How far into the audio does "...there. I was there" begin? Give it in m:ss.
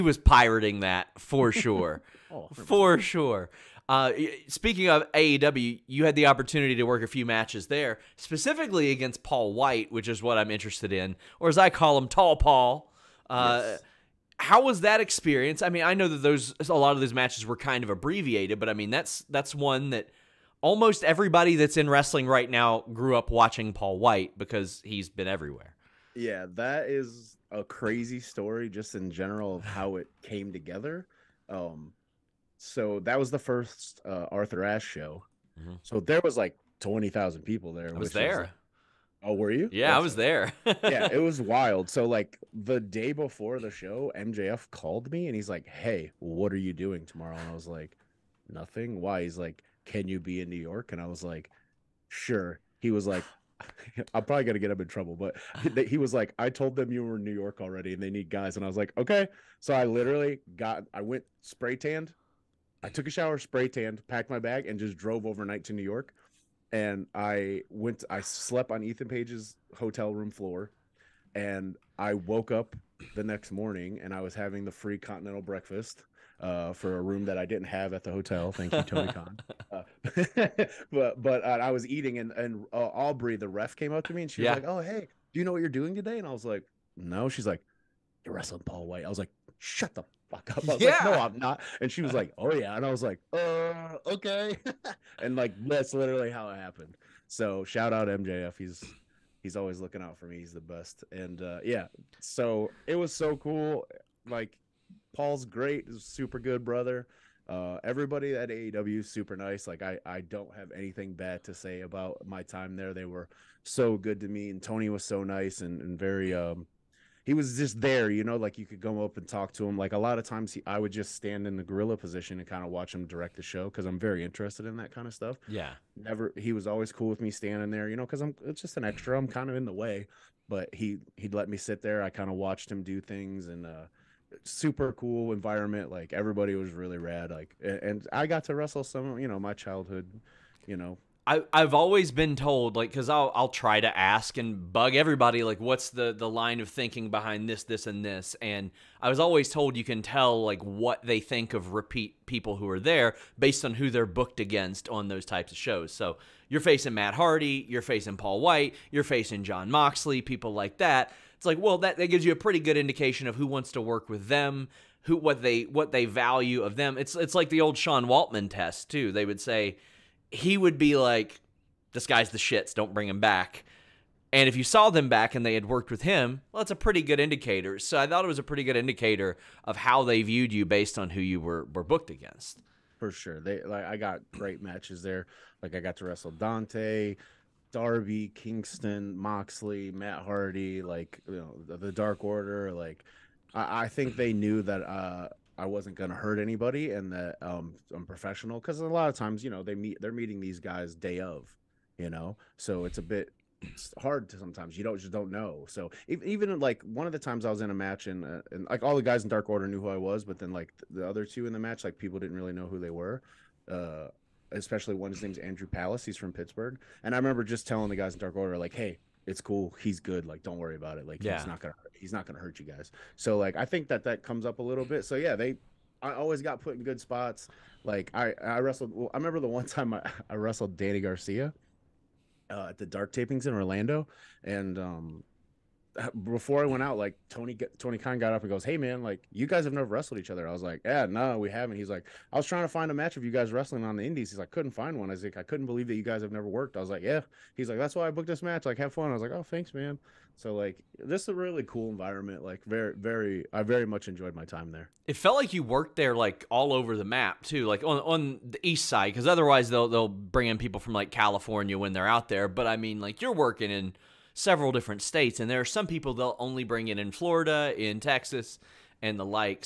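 0:37.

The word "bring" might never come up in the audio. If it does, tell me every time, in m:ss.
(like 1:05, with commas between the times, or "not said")
2:52, 4:20, 4:26.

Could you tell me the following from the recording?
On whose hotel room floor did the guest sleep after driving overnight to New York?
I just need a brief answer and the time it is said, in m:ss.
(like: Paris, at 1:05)
Ethan Page, at 1:08.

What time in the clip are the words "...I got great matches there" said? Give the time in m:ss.
3:03.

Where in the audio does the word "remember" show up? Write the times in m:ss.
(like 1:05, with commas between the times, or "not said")
3:37, 3:49.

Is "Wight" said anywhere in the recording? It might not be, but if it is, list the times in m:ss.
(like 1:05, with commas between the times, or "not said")
0:09, 0:23, 1:28, 2:38.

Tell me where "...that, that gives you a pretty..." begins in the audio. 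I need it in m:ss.
2:41.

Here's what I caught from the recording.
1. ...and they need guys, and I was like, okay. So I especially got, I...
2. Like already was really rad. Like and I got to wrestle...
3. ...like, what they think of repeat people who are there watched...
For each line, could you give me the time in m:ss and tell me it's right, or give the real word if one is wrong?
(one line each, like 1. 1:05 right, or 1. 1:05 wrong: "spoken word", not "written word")
1. 0:57 wrong: "literally", not "especially"
2. 2:15 wrong: "everybody", not "already"
3. 2:30 wrong: "based", not "watched".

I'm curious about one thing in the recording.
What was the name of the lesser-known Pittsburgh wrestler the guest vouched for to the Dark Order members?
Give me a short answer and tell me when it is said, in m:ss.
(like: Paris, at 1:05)
Andrew Palace, at 3:35.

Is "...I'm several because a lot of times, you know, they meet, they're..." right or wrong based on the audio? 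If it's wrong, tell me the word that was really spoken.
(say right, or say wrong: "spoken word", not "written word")
wrong: "professional", not "several".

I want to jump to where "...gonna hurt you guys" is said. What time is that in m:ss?
3:42.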